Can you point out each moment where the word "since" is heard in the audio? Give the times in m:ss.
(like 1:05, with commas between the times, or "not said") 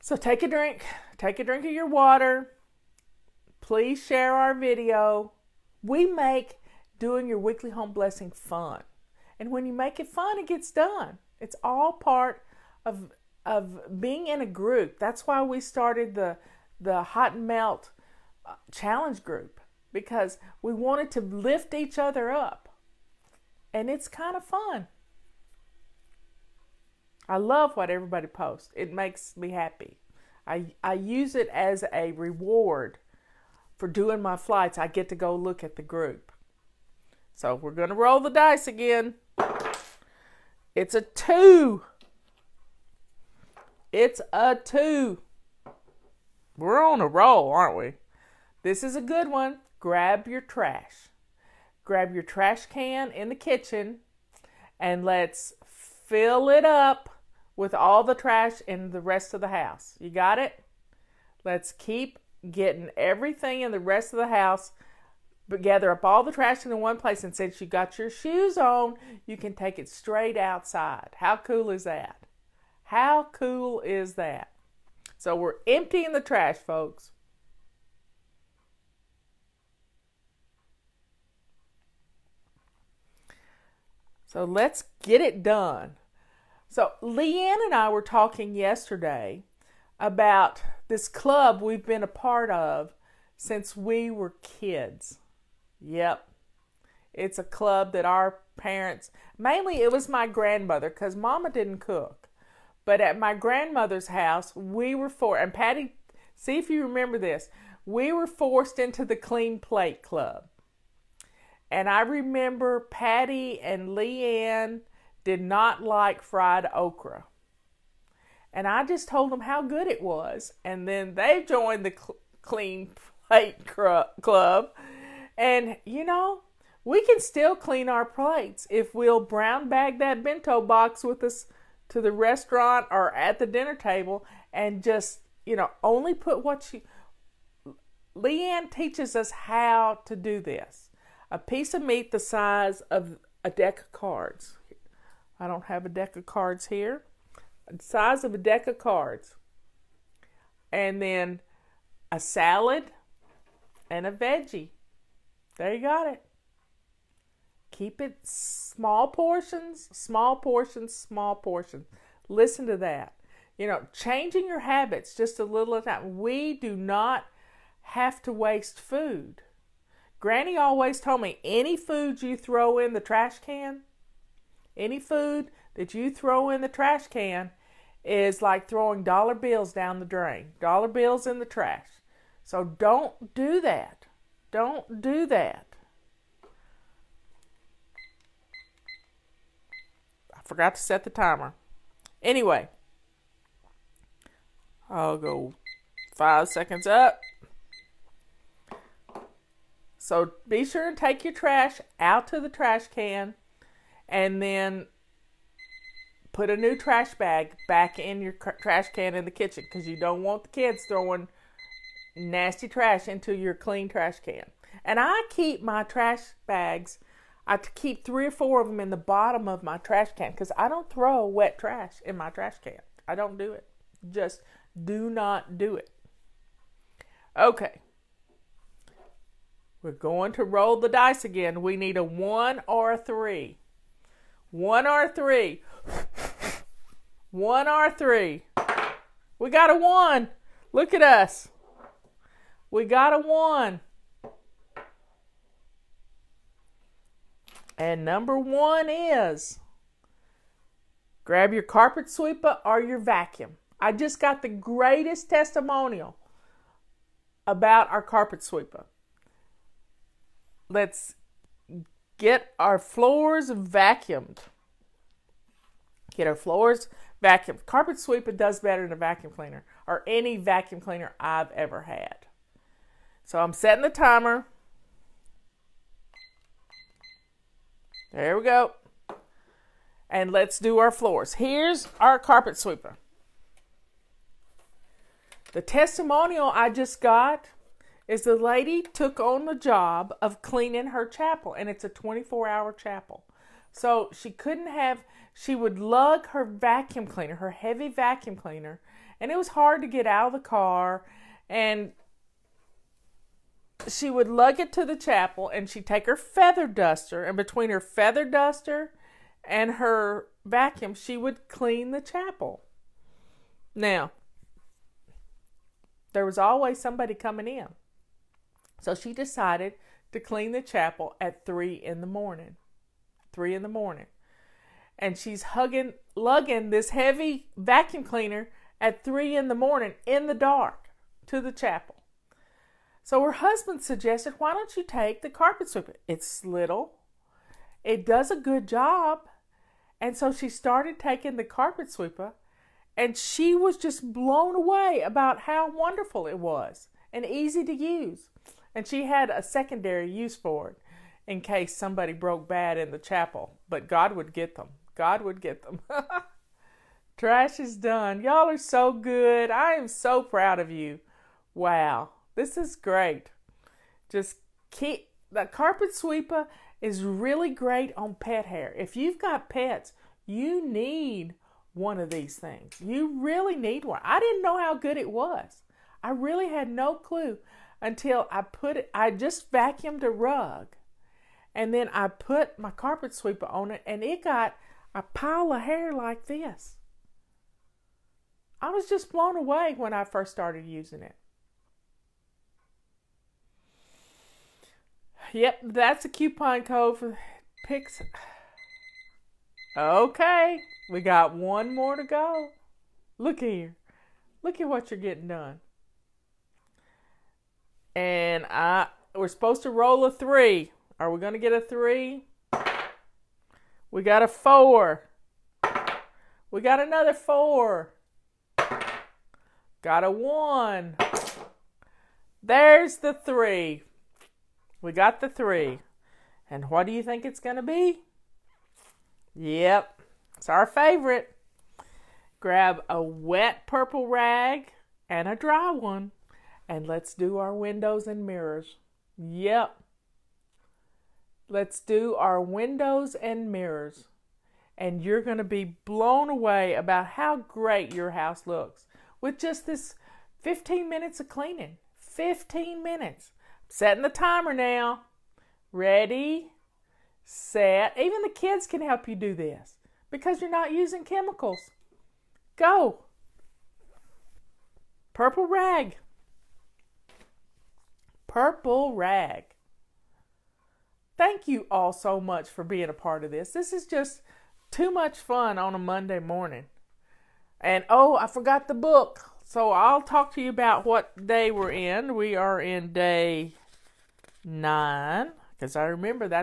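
1:07, 1:33.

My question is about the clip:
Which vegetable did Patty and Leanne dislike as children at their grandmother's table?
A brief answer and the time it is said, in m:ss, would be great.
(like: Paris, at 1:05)
fried okra, at 1:56.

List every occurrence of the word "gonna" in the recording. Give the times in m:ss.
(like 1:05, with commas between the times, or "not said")
0:37, 6:51.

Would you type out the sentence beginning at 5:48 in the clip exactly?
And she had a secondary use for it in case somebody broke bad in the chapel.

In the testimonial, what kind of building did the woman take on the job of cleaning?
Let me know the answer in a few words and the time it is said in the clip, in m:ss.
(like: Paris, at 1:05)
a 24 hour chapel, at 4:51.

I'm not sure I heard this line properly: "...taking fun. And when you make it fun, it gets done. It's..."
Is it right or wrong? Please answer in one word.
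wrong.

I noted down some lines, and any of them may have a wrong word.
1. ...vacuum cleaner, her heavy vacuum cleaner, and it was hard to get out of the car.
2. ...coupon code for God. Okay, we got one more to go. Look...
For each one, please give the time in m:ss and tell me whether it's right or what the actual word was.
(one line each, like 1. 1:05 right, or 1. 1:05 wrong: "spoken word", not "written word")
1. 4:56 right
2. 6:36 wrong: "Pix", not "God".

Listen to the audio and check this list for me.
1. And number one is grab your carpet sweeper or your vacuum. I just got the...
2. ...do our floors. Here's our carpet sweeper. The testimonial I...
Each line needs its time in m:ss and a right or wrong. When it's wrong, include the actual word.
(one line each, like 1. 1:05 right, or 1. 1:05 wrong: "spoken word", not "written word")
1. 4:07 right
2. 4:40 right.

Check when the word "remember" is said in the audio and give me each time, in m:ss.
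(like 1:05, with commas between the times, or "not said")
1:46, 1:52, 8:05.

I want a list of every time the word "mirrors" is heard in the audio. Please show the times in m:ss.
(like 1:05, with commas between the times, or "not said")
7:18, 7:23.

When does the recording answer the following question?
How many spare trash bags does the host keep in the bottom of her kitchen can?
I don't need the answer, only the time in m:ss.
3:38.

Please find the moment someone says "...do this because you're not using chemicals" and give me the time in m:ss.
7:39.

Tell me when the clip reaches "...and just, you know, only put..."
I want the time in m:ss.
2:14.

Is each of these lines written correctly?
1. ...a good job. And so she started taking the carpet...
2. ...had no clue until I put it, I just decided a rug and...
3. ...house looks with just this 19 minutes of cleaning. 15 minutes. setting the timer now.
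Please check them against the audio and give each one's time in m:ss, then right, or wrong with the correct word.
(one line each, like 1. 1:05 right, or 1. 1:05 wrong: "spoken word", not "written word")
1. 5:38 right
2. 6:16 wrong: "vacuumed", not "decided"
3. 7:28 wrong: "15", not "19".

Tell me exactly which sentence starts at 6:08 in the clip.
If you've got pets, you need one of these things.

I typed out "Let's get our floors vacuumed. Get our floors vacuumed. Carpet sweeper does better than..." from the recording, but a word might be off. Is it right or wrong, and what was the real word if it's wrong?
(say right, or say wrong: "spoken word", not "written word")
right.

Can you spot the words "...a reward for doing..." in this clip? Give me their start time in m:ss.
0:31.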